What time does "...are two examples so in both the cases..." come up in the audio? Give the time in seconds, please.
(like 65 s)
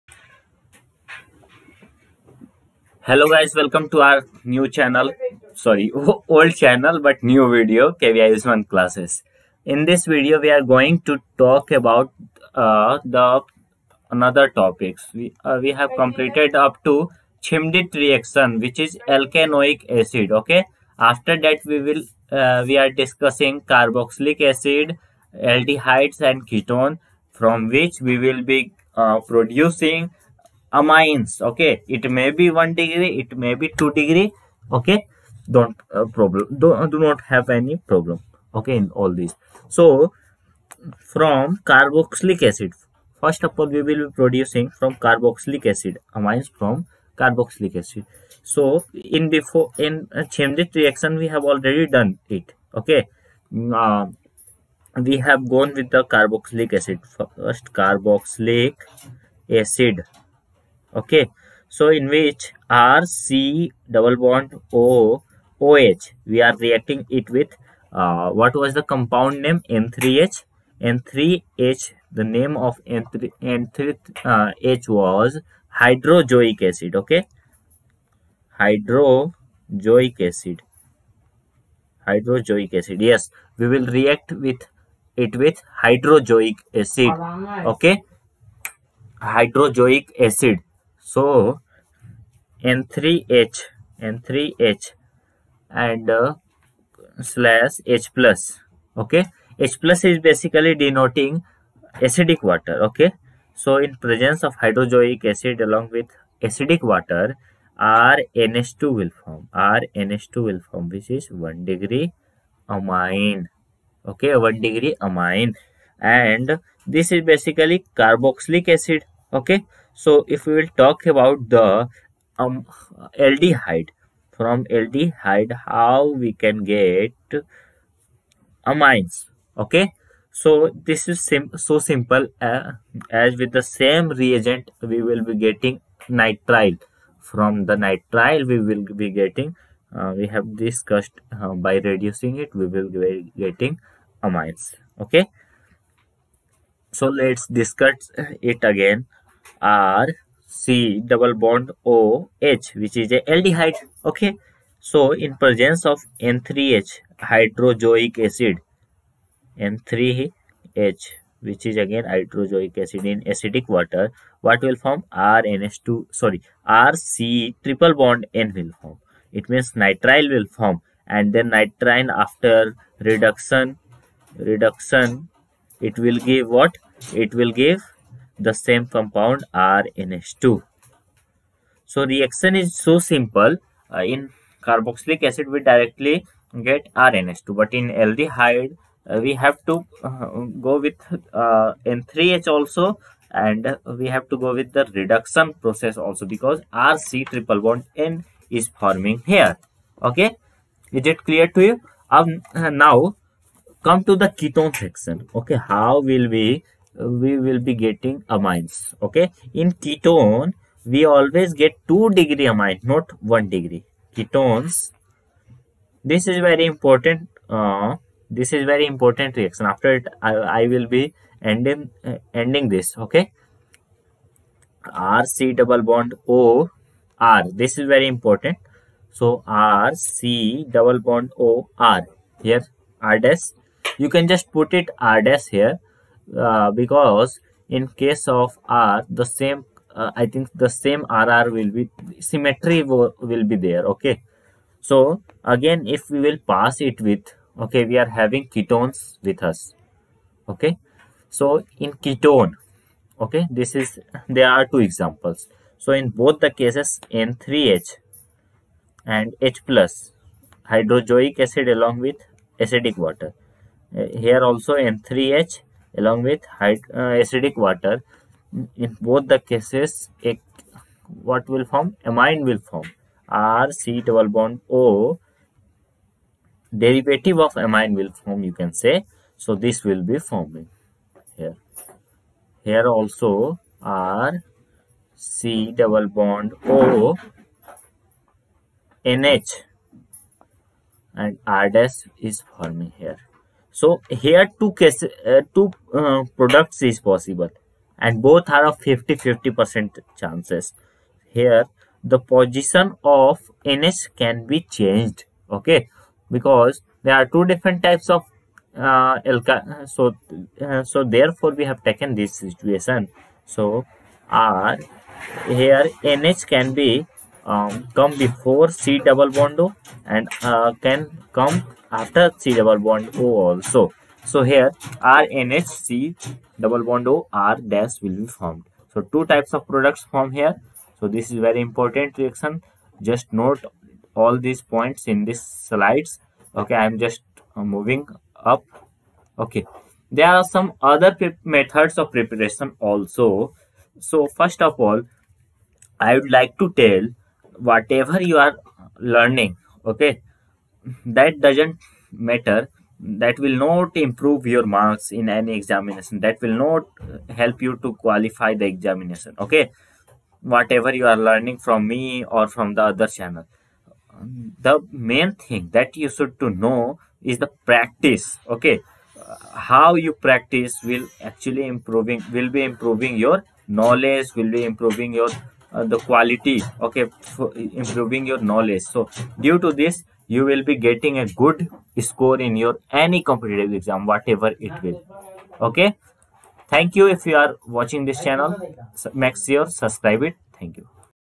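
254 s.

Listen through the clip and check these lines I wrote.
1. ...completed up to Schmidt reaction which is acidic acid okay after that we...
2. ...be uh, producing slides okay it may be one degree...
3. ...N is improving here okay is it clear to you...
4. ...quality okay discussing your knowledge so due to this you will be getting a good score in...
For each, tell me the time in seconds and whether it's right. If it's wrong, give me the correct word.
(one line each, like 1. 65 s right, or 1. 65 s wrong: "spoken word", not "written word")
1. 15 s wrong: "alkanoic", not "acidic"
2. 28 s wrong: "amines", not "slides"
3. 197 s wrong: "forming", not "improving"
4. 375 s wrong: "improving", not "discussing".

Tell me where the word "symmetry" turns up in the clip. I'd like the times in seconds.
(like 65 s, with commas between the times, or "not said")
242 s.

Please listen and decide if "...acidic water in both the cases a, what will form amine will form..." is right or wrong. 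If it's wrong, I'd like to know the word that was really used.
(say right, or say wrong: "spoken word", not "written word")
right.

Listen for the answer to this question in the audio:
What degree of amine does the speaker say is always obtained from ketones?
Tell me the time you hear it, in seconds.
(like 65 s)
211 s.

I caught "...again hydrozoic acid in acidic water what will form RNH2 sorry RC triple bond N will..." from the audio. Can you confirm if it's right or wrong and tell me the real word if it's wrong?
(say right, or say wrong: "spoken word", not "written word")
right.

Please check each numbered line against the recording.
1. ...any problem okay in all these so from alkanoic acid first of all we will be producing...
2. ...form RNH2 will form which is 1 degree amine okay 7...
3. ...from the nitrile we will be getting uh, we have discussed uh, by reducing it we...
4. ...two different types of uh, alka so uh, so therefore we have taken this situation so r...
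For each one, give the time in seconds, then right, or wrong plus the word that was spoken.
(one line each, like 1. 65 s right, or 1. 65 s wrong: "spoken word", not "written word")
1. 37 s wrong: "carboxylic", not "alkanoic"
2. 109 s wrong: "1", not "7"
3. 137 s right
4. 307 s right.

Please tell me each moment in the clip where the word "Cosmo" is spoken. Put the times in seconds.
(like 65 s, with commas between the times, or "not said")
not said.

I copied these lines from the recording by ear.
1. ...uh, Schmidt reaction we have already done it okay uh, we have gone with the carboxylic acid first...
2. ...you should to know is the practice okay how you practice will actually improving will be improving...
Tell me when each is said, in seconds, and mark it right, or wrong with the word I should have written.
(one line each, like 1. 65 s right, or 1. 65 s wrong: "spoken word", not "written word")
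1. 50 s right
2. 365 s right.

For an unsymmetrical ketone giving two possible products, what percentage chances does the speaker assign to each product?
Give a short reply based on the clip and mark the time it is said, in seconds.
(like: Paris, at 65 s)
50-50%, at 298 s.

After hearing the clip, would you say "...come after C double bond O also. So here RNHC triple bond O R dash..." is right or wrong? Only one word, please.
wrong.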